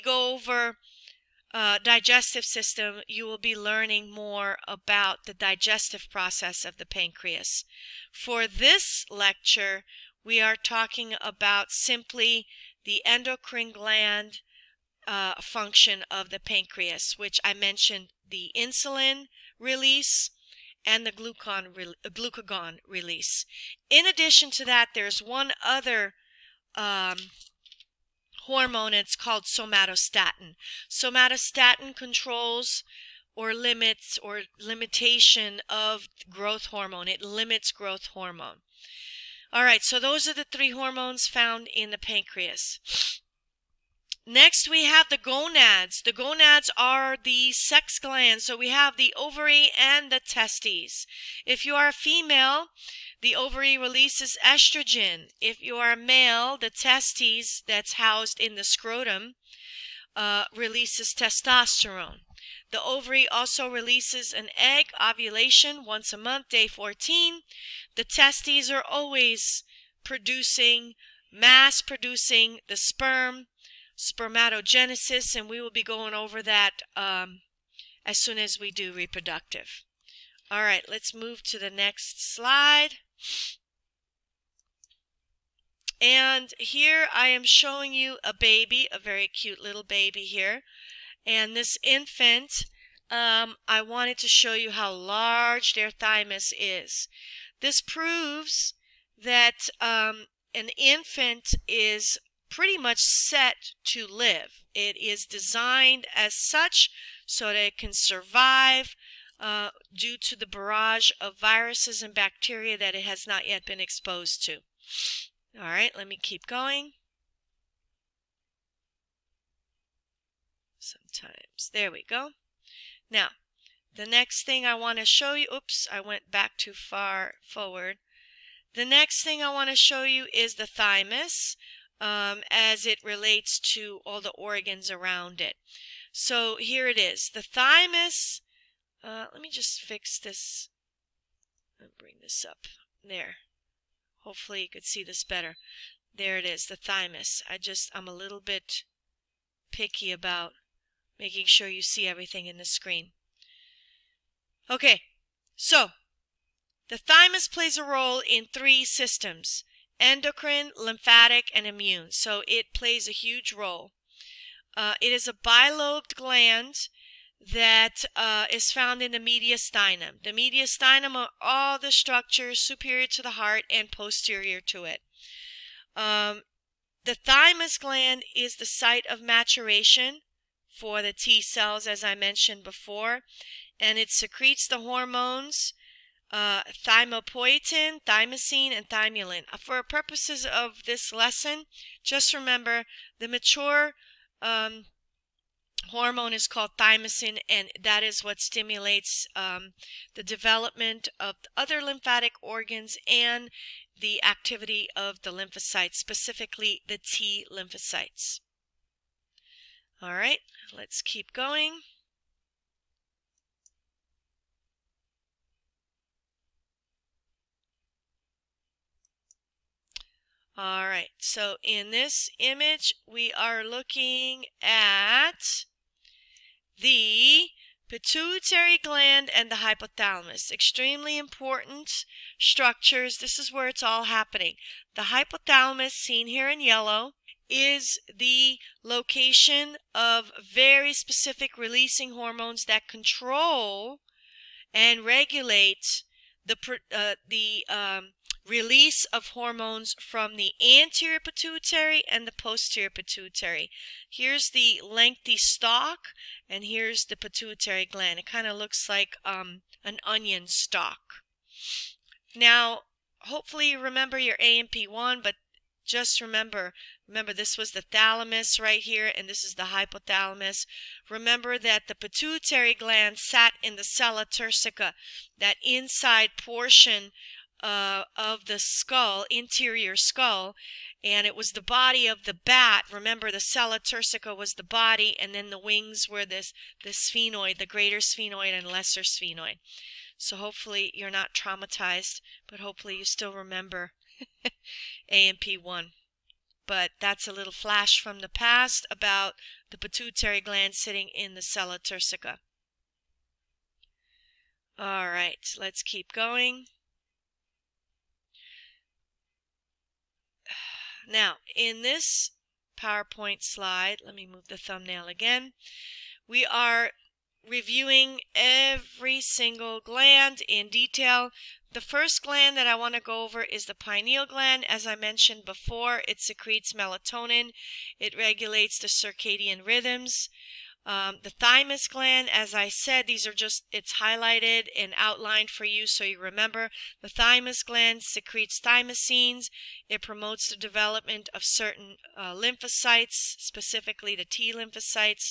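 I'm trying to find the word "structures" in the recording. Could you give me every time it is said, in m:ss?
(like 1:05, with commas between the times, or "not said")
2:51, 3:52.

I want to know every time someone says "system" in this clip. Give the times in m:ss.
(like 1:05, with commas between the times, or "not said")
0:02, 2:38.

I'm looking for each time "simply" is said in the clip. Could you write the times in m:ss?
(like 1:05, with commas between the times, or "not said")
0:11.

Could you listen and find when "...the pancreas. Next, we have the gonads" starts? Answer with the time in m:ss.
0:41.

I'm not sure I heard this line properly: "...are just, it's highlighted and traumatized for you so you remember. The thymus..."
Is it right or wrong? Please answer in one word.
wrong.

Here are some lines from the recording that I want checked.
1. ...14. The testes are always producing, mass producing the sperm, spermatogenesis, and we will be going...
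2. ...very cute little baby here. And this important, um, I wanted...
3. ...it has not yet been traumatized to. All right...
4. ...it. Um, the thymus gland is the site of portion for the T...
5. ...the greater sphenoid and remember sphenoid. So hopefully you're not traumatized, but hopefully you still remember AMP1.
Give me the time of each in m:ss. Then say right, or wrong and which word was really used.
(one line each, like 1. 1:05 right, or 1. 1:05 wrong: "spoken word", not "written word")
1. 1:06 right
2. 1:28 wrong: "infant", not "important"
3. 1:52 wrong: "exposed", not "traumatized"
4. 2:54 wrong: "maturation", not "portion"
5. 4:47 wrong: "lesser", not "remember".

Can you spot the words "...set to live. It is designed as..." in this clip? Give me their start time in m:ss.
1:43.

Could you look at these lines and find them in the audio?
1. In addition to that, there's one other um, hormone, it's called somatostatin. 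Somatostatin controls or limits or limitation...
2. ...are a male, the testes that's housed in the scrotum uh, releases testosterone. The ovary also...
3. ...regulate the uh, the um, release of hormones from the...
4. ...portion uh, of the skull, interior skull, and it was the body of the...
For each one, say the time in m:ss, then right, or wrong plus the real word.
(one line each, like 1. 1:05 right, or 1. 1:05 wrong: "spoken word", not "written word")
1. 0:23 right
2. 0:55 right
3. 4:05 right
4. 4:36 right.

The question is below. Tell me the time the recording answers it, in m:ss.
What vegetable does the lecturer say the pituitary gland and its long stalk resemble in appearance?
4:20.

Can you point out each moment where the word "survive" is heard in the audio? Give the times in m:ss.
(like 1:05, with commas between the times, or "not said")
1:47.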